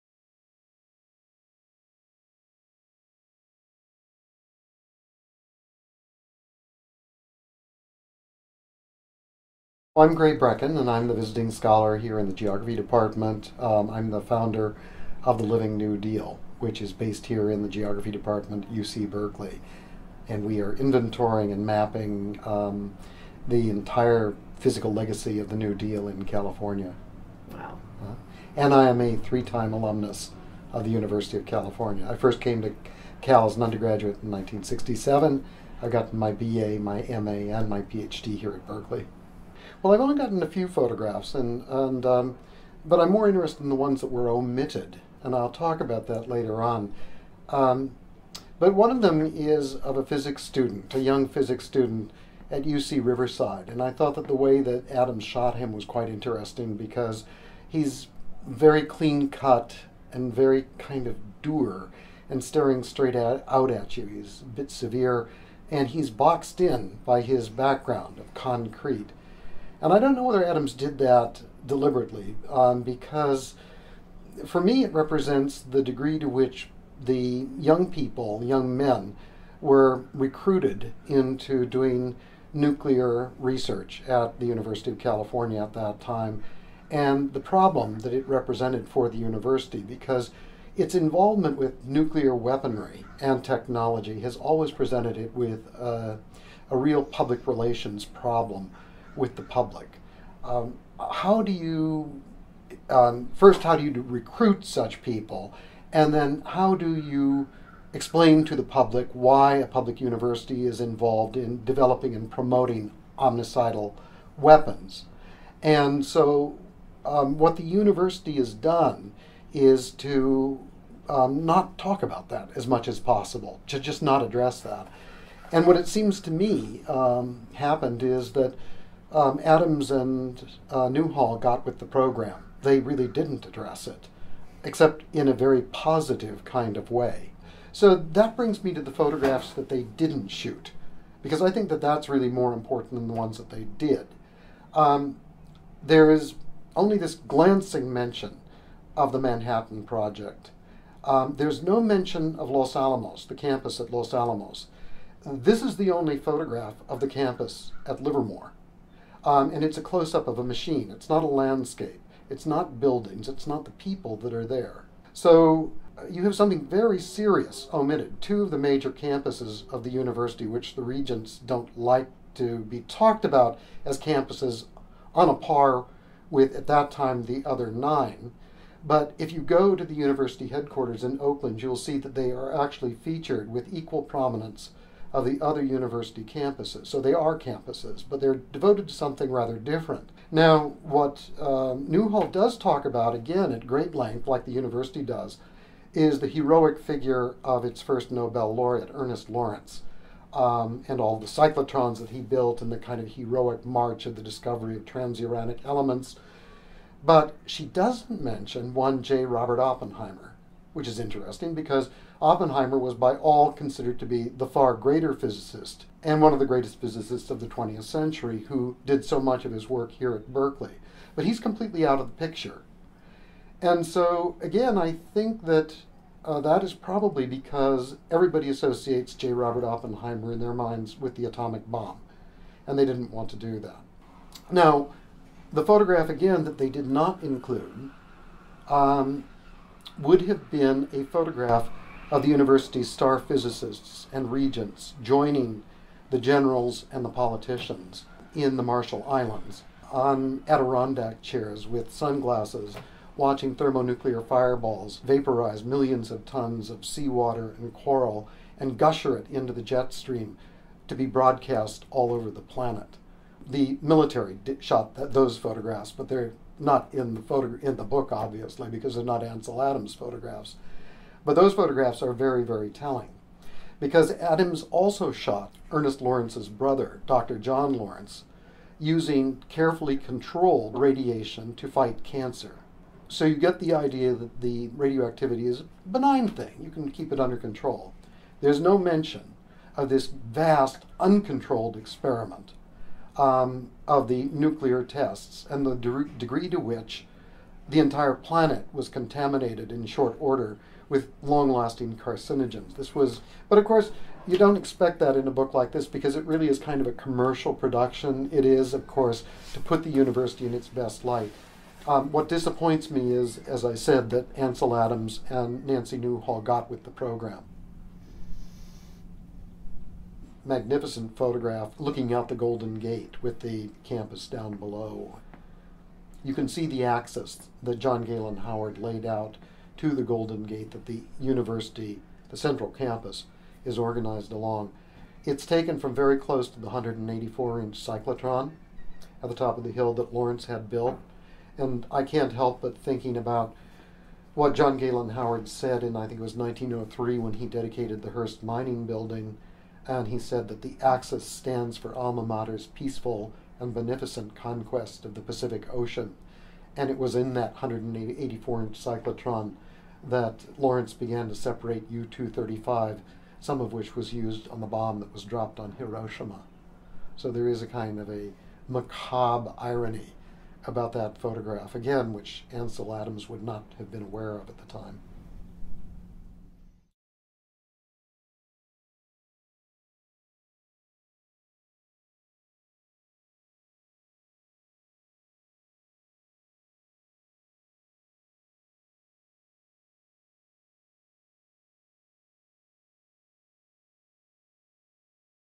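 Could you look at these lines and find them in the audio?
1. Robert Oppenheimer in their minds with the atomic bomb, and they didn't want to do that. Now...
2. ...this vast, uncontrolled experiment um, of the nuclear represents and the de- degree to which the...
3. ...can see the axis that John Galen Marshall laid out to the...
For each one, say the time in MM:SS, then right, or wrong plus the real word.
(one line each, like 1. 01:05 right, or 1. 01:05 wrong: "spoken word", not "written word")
1. 03:49 right
2. 04:49 wrong: "tests", not "represents"
3. 05:26 wrong: "Howard", not "Marshall".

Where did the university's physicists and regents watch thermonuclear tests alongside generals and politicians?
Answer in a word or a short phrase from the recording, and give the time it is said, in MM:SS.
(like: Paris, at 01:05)
Marshall Islands, at 04:08.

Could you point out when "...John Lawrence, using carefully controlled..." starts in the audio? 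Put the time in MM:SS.
04:37.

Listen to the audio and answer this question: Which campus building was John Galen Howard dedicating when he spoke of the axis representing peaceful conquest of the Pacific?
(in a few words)
Hearst Mining Building.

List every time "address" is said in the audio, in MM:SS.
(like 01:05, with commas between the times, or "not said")
02:04, 02:13.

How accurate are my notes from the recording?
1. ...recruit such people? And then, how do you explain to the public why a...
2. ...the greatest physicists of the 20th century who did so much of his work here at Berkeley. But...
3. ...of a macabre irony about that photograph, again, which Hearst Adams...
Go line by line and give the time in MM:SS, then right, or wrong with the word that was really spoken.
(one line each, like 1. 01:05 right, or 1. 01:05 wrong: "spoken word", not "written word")
1. 01:44 right
2. 03:36 right
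3. 06:07 wrong: "Ansel", not "Hearst".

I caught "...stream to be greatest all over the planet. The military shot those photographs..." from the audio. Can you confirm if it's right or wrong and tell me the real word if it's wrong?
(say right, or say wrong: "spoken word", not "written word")
wrong: "broadcast", not "greatest".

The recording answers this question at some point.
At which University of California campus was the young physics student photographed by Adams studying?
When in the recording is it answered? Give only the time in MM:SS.
00:52.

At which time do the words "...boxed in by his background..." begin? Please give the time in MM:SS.
01:06.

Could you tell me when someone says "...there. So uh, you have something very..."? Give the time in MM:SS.
02:44.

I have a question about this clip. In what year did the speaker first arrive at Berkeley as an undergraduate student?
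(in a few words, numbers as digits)
1967.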